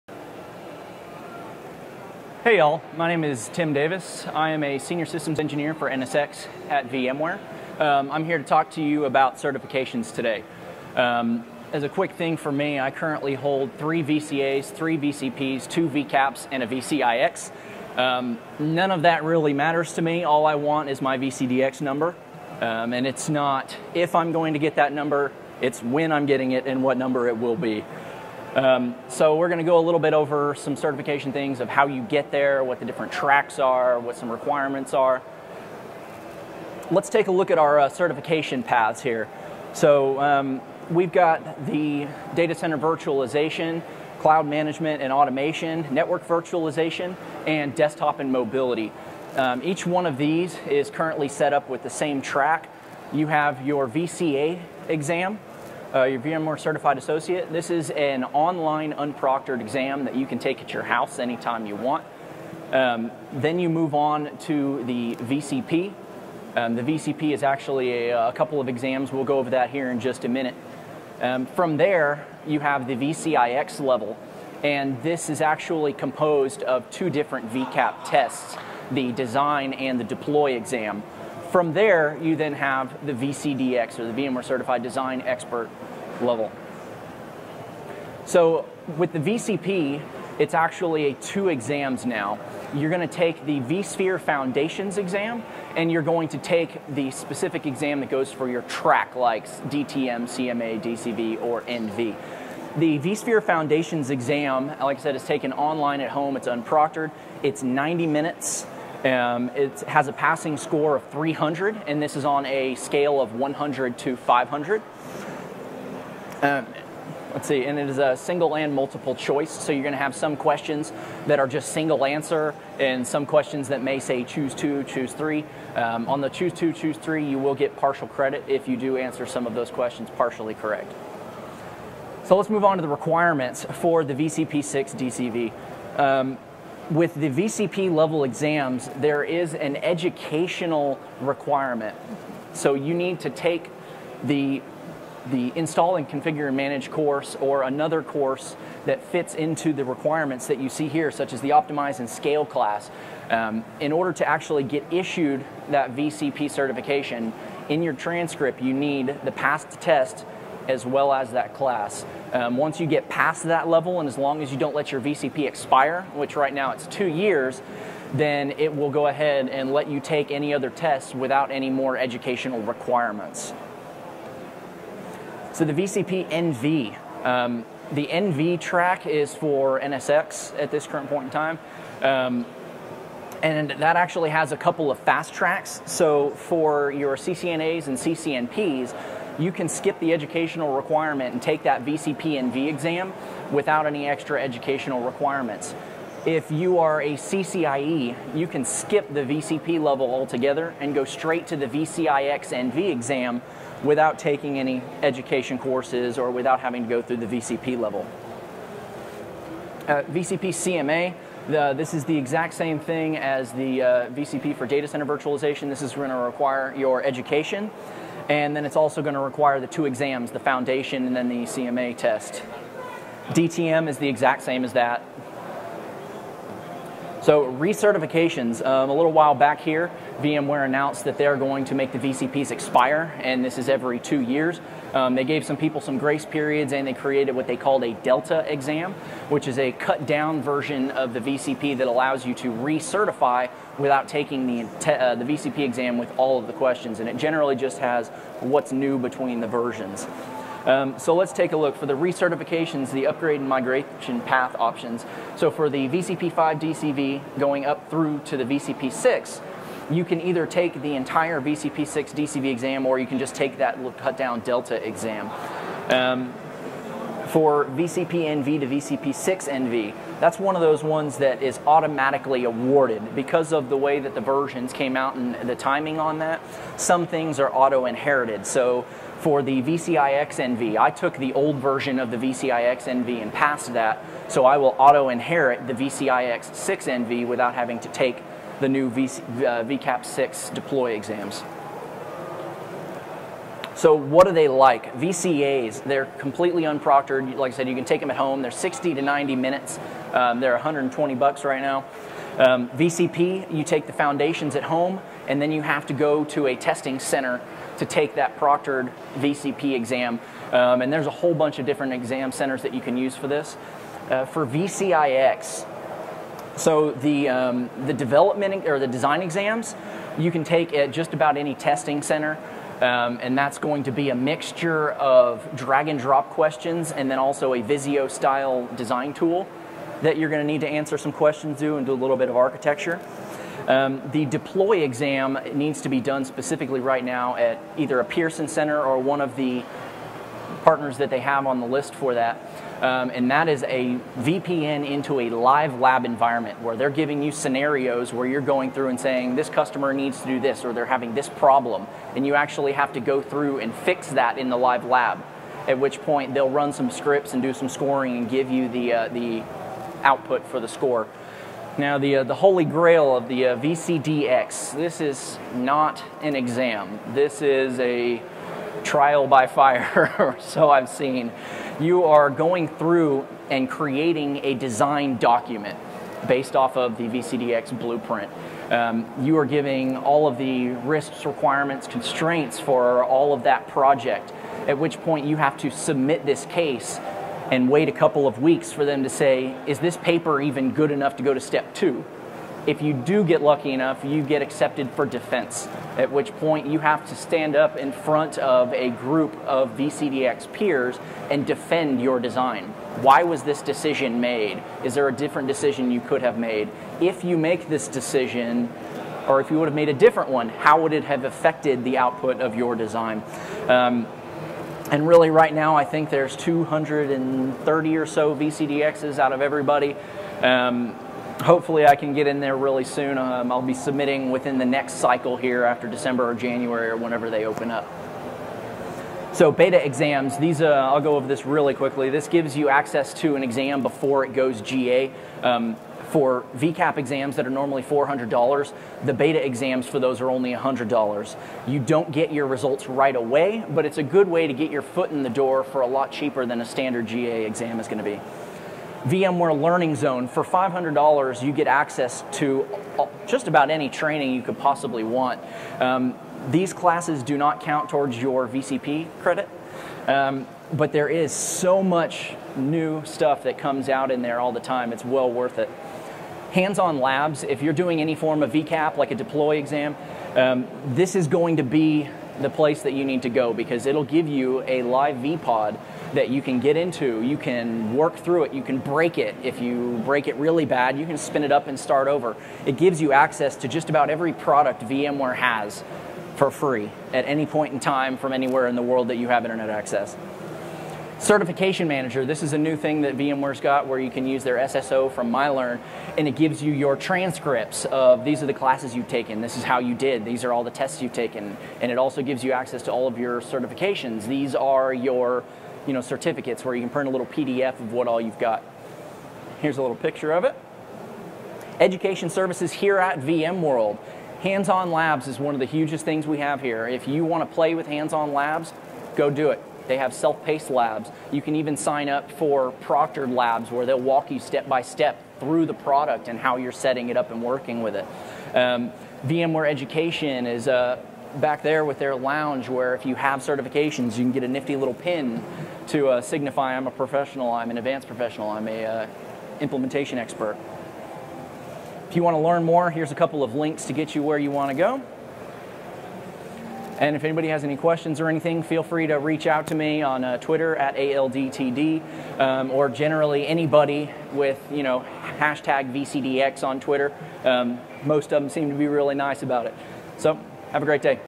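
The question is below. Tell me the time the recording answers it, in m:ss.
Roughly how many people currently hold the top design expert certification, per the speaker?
6:56.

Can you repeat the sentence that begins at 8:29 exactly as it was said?
Here's a little picture of it.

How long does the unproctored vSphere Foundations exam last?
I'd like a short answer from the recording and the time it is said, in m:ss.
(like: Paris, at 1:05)
90 minutes, at 1:47.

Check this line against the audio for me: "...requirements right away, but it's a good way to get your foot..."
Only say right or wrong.
wrong.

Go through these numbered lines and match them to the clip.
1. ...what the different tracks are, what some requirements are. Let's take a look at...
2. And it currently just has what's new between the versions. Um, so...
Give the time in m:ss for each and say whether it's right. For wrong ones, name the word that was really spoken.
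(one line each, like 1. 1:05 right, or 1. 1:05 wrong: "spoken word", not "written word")
1. 0:32 right
2. 4:07 wrong: "generally", not "currently".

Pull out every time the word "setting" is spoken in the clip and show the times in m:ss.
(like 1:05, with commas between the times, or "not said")
8:46.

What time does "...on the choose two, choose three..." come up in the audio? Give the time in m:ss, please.
2:06.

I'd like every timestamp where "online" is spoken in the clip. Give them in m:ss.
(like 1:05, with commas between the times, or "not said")
0:58, 1:45.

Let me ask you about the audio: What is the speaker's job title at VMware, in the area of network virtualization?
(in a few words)
Senior Systems Engineer.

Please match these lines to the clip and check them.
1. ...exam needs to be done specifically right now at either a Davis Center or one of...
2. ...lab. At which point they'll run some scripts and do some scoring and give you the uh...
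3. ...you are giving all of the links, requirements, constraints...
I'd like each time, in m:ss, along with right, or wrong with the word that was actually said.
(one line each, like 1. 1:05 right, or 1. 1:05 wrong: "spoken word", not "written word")
1. 5:34 wrong: "Pearson", not "Davis"
2. 5:54 right
3. 6:19 wrong: "risks", not "links".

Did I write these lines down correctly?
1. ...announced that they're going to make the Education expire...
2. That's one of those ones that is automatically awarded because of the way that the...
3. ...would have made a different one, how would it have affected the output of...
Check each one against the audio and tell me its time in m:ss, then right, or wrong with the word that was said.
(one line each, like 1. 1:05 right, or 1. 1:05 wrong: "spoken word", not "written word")
1. 3:50 wrong: "VCPs", not "Education"
2. 4:30 right
3. 6:49 right.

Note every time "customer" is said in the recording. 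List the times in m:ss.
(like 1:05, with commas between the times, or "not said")
5:49.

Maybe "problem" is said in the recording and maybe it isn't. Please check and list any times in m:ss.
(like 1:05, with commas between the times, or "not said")
5:51.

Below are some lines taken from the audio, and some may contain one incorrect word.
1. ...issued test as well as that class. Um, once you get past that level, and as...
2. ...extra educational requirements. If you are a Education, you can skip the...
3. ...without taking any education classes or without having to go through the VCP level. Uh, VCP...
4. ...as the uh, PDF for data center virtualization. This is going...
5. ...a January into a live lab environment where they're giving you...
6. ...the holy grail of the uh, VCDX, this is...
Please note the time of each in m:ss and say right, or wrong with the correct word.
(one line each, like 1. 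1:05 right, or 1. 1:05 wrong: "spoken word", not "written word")
1. 2:39 wrong: "passed", not "issued"
2. 3:14 wrong: "CCIE", not "Education"
3. 3:23 wrong: "courses", not "classes"
4. 3:33 wrong: "VCP", not "PDF"
5. 5:43 wrong: "VPN", not "January"
6. 6:02 right.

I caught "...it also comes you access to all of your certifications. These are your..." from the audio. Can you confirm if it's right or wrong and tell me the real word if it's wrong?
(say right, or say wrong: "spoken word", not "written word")
wrong: "gives", not "comes".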